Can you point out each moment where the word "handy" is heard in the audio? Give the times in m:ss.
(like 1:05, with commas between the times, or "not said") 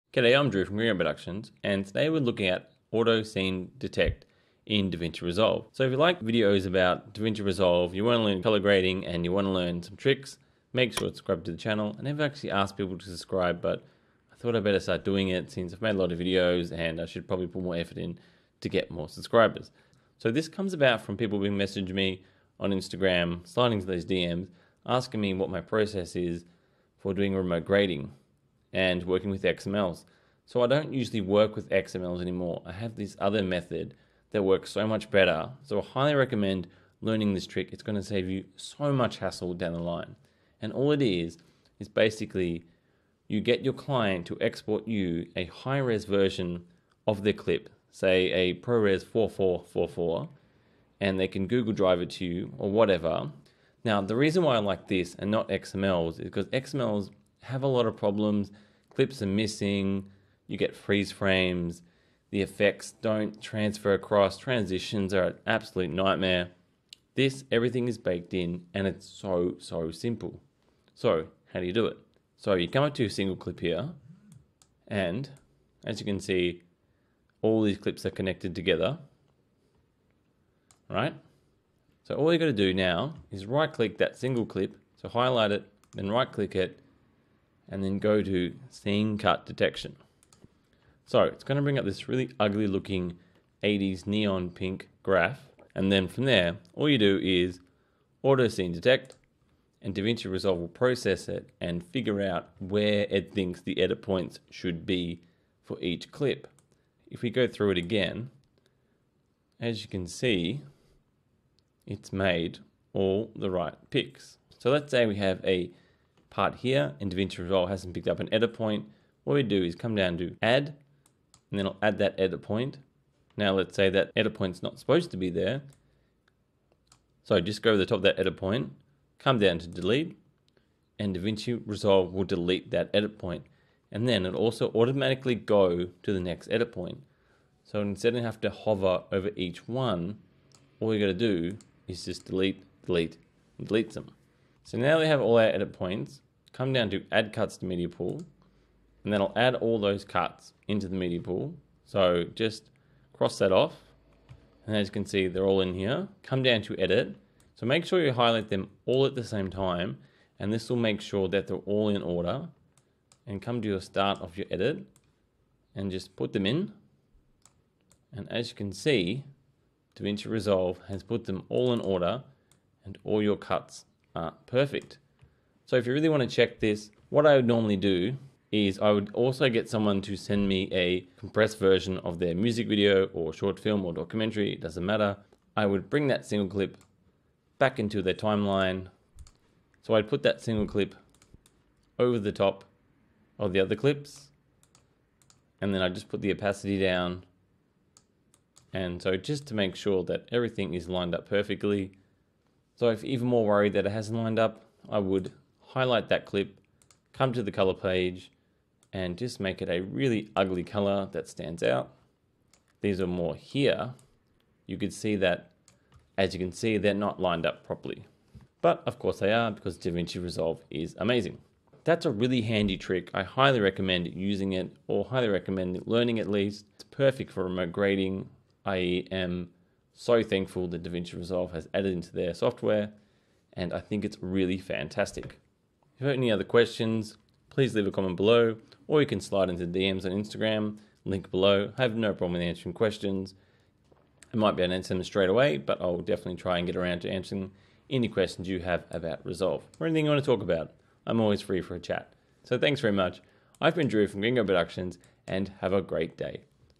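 3:42.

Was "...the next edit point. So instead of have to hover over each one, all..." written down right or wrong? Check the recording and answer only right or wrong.
right.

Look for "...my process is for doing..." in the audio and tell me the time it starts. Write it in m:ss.
0:25.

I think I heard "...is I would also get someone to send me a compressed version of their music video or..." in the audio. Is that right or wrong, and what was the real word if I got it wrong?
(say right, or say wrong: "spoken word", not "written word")
right.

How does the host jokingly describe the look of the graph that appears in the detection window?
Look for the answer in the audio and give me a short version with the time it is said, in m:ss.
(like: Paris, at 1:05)
80s neon pink, at 1:33.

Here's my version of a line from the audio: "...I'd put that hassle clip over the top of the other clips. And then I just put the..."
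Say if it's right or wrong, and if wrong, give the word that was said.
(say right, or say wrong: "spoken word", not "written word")
wrong: "single", not "hassle".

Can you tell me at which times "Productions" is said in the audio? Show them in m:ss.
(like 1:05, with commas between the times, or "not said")
0:00, 4:14.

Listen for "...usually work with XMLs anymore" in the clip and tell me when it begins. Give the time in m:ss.
0:30.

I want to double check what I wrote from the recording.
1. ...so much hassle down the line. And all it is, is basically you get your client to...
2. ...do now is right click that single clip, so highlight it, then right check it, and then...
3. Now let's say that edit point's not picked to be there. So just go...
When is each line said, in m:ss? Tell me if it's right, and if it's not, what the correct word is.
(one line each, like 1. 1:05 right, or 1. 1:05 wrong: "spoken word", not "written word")
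1. 0:38 right
2. 1:22 wrong: "click", not "check"
3. 2:03 wrong: "supposed", not "picked".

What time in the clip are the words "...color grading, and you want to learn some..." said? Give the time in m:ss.
0:08.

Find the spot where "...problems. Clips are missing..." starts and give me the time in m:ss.
0:57.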